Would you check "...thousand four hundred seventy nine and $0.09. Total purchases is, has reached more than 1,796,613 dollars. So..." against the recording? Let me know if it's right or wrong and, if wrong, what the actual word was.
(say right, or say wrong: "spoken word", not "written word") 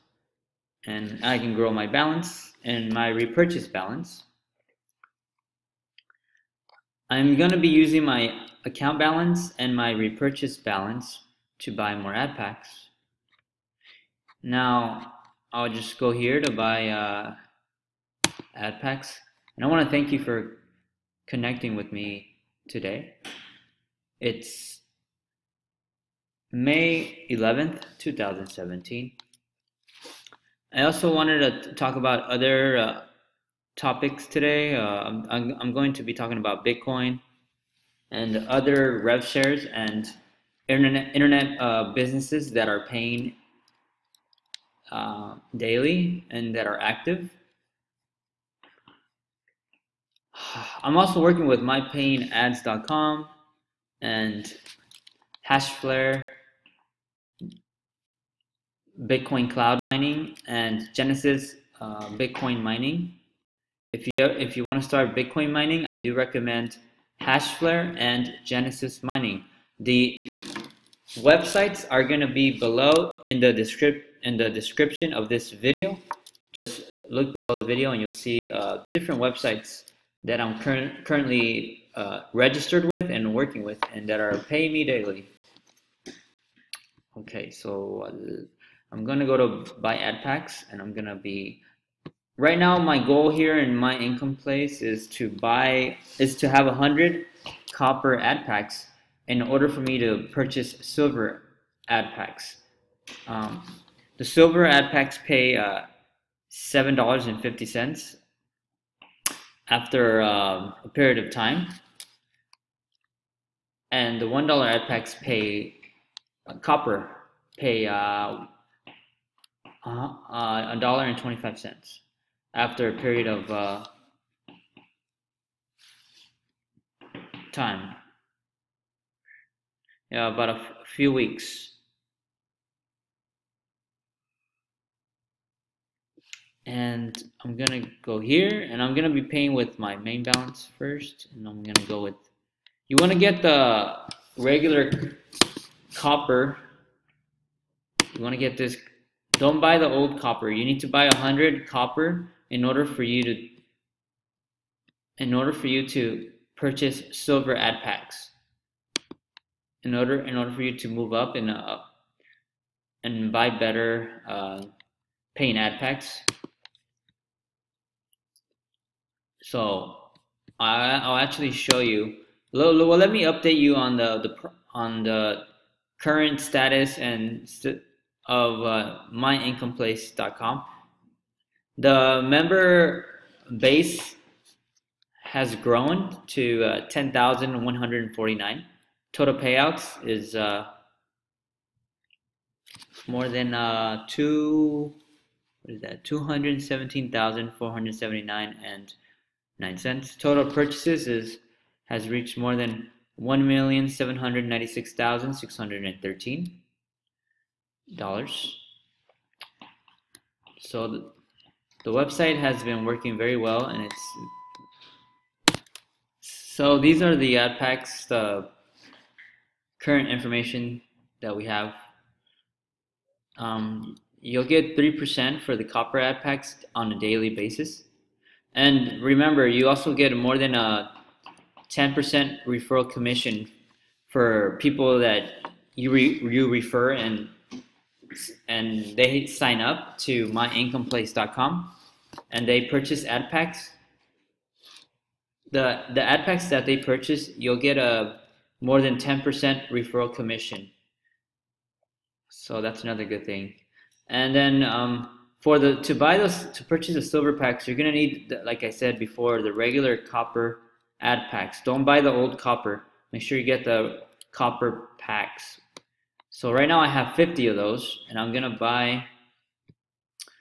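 right.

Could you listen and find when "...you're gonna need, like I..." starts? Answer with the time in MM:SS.
04:17.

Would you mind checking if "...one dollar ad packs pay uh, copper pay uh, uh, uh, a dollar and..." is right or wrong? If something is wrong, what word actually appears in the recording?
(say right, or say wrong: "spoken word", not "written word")
right.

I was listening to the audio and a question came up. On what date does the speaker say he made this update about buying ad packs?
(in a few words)
May 11th, 2017.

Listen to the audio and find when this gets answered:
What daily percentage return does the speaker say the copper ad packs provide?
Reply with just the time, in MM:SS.
03:44.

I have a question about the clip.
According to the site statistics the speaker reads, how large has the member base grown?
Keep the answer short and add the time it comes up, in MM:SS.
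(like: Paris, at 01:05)
10,149, at 03:06.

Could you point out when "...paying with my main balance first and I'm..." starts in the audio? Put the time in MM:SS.
02:19.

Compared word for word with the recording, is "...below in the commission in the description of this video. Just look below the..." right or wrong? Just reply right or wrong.
wrong.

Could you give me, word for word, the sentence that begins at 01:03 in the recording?
If you if you want to start Bitcoin mining, I do recommend Hashflare and Genesis mining.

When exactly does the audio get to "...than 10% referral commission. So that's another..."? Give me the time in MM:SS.
04:08.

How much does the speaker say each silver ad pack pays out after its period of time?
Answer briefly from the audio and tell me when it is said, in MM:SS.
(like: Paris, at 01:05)
$7.50, at 01:46.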